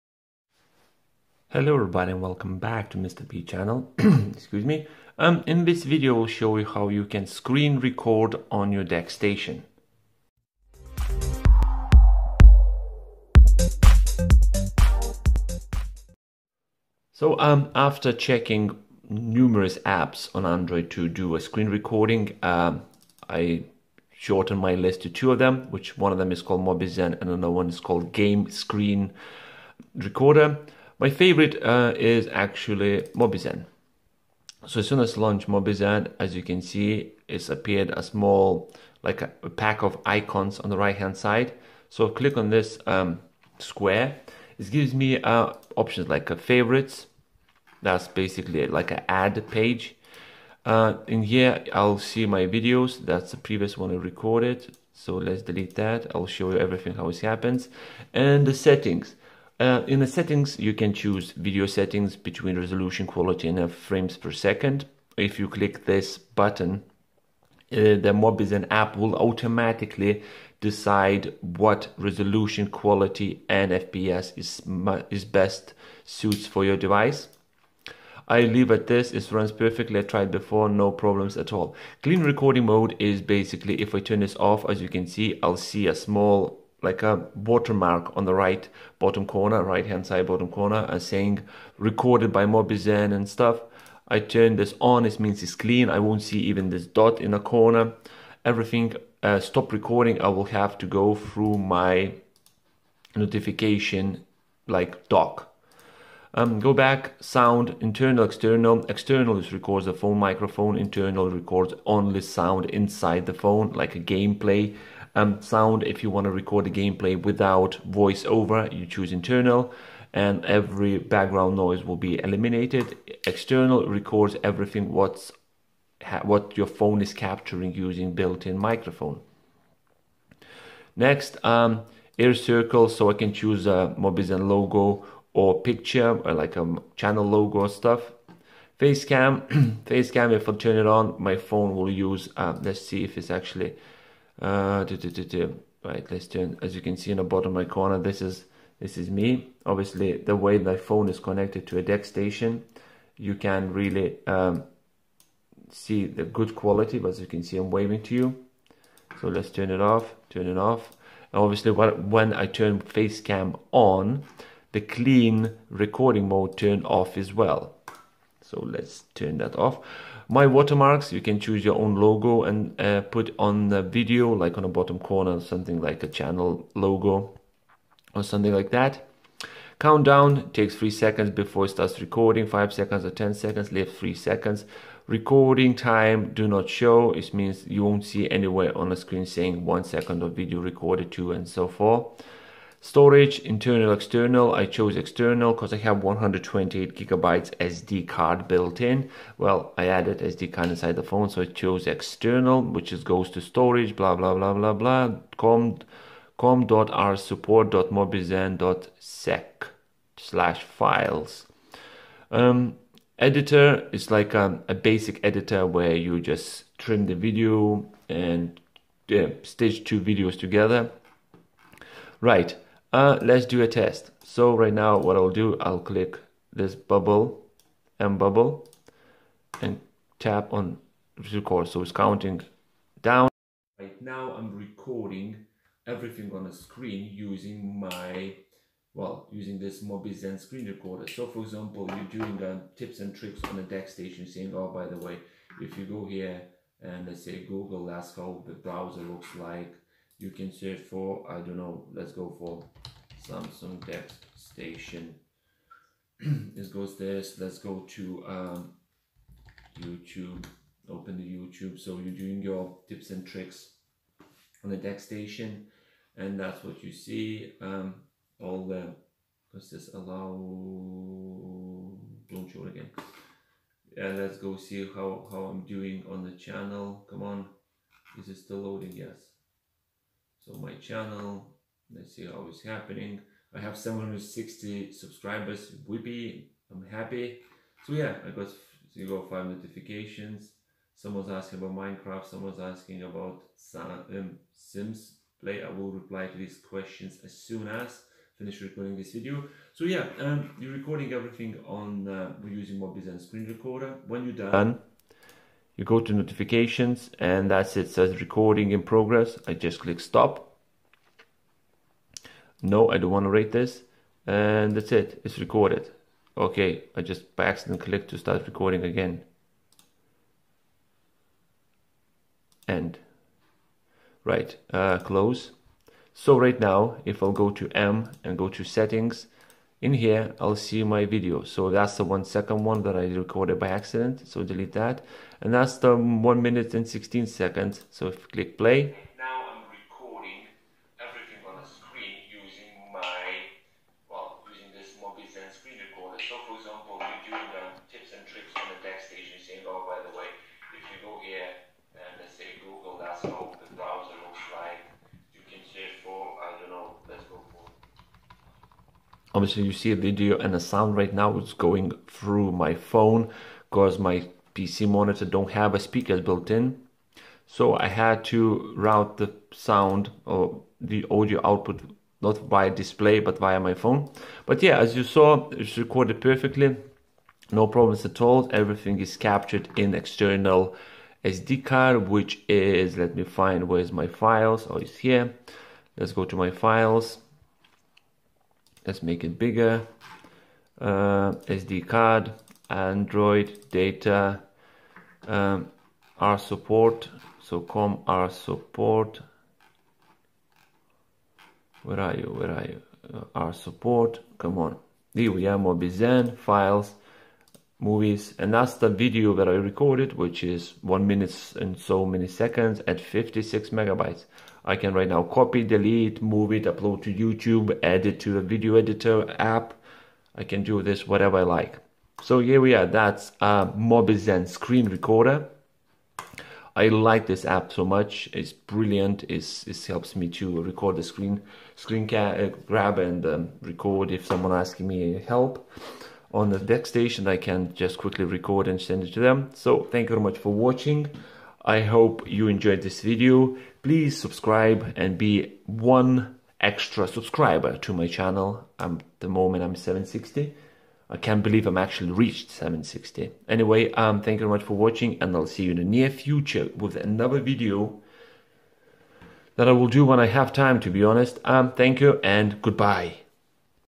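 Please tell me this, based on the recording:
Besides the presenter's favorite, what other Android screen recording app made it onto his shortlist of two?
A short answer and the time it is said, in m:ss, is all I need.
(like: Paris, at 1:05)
Game Screen Recorder, at 0:28.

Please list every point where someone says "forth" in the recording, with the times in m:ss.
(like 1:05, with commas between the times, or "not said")
3:11.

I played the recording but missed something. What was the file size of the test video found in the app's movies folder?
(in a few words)
56 megabytes.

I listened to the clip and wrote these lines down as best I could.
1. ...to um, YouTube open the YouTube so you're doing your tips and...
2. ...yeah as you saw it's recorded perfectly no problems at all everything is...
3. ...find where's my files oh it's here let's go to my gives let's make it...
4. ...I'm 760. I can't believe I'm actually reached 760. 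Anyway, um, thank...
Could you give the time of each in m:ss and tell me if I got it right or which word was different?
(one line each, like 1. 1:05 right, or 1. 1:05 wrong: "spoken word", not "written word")
1. 4:17 right
2. 6:14 right
3. 6:23 wrong: "files", not "gives"
4. 7:29 right.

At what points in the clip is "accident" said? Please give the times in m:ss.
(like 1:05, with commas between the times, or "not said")
5:17, 5:33.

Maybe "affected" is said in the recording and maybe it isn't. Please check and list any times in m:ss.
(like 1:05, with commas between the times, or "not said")
not said.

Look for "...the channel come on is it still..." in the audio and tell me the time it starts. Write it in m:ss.
4:36.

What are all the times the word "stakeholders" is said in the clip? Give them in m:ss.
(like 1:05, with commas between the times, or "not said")
not said.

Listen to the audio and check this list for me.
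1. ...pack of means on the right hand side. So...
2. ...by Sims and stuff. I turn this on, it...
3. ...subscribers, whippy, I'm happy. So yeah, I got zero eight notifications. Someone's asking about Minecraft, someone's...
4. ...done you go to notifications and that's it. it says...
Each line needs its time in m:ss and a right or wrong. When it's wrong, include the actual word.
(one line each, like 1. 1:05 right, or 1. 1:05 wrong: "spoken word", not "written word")
1. 0:39 wrong: "icons", not "means"
2. 1:32 wrong: "Mobizen", not "Sims"
3. 4:44 wrong: "five", not "eight"
4. 5:04 right.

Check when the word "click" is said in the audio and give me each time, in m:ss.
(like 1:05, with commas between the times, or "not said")
0:42, 1:05, 3:45, 5:09, 5:17, 5:38.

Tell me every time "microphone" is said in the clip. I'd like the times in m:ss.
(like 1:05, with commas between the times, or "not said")
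1:50, 2:08.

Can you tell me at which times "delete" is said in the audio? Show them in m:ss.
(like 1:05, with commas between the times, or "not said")
0:55, 5:34, 6:55.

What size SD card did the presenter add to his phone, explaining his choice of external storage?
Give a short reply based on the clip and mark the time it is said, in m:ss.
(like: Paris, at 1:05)
128 gigabytes, at 3:16.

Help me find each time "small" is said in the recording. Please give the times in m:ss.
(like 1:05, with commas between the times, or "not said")
0:38, 1:25.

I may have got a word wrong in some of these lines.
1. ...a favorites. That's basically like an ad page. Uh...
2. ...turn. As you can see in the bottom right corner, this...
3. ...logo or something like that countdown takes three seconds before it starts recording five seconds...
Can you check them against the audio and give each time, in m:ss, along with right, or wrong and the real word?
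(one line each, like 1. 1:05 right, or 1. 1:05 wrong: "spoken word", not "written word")
1. 0:46 right
2. 2:26 right
3. 2:56 right.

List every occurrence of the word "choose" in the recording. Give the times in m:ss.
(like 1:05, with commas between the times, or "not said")
1:00, 1:58, 2:13, 2:51.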